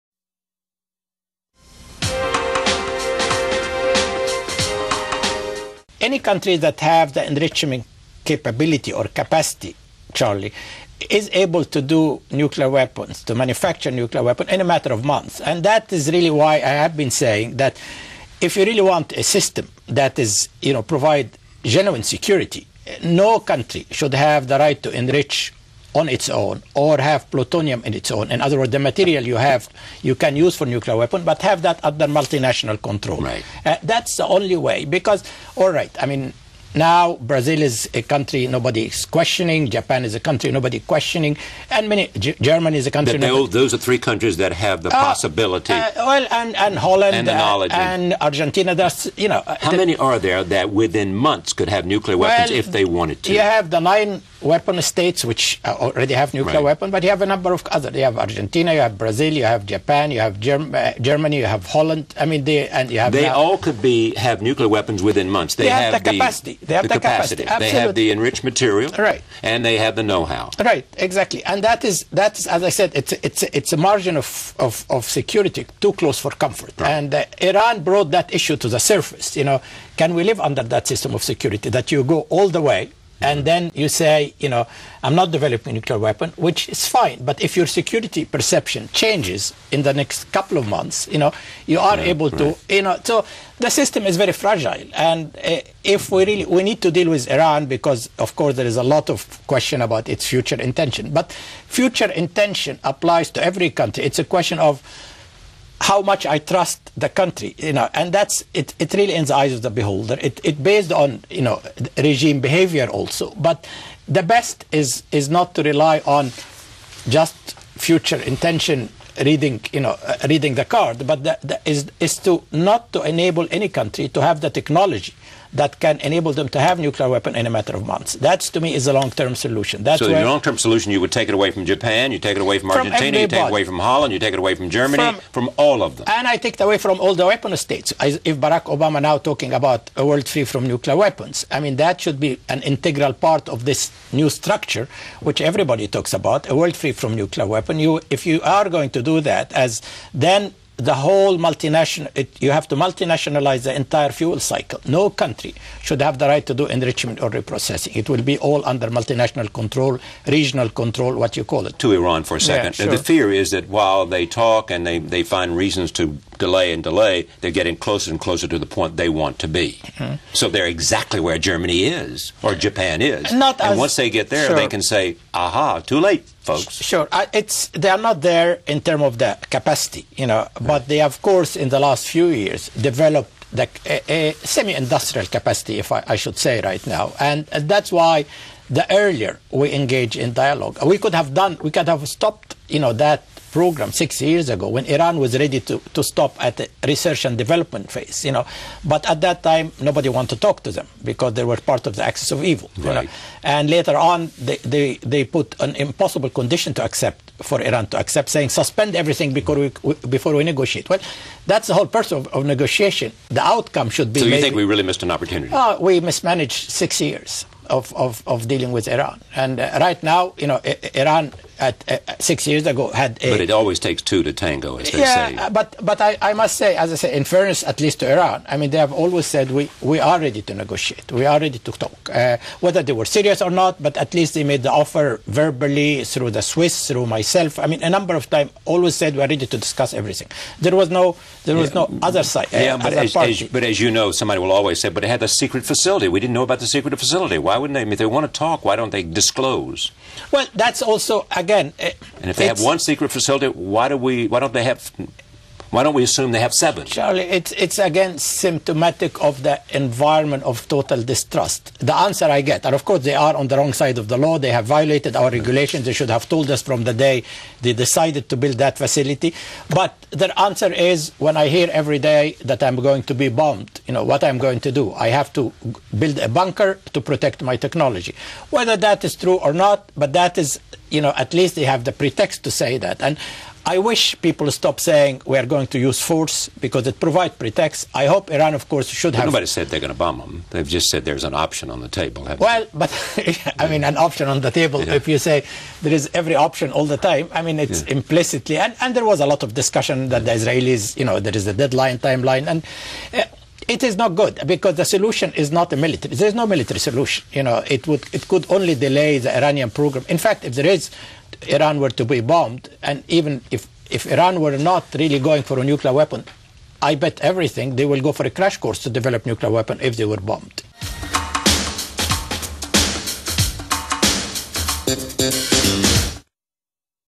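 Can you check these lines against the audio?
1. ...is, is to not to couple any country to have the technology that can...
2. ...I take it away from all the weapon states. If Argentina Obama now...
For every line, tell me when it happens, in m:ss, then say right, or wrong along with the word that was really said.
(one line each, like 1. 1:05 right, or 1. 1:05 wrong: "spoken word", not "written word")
1. 2:01 wrong: "enable", not "couple"
2. 2:16 wrong: "Barack", not "Argentina".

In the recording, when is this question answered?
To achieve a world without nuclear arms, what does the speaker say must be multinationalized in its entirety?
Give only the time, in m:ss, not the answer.
2:33.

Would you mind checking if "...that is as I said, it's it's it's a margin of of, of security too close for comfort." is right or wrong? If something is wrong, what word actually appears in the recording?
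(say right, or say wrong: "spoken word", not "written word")
right.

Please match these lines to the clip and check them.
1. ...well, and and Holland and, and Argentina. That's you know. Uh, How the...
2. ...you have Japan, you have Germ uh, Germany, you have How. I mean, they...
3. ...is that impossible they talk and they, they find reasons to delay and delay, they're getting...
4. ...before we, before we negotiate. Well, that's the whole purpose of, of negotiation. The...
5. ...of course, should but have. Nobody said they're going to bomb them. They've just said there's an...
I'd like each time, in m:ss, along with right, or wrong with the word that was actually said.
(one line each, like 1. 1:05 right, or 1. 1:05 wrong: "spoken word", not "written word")
1. 0:45 right
2. 0:59 wrong: "Holland", not "How"
3. 2:43 wrong: "while", not "impossible"
4. 3:29 right
5. 4:48 right.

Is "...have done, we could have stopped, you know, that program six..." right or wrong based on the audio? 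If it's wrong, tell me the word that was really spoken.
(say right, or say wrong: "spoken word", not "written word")
right.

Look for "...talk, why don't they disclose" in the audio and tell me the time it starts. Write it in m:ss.
4:08.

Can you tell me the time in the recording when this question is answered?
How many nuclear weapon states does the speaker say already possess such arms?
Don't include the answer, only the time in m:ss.
0:53.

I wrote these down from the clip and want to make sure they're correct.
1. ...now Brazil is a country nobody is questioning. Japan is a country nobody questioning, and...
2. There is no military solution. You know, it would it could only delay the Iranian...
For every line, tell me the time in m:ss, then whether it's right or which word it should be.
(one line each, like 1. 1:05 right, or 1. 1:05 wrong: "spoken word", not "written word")
1. 0:36 right
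2. 5:06 right.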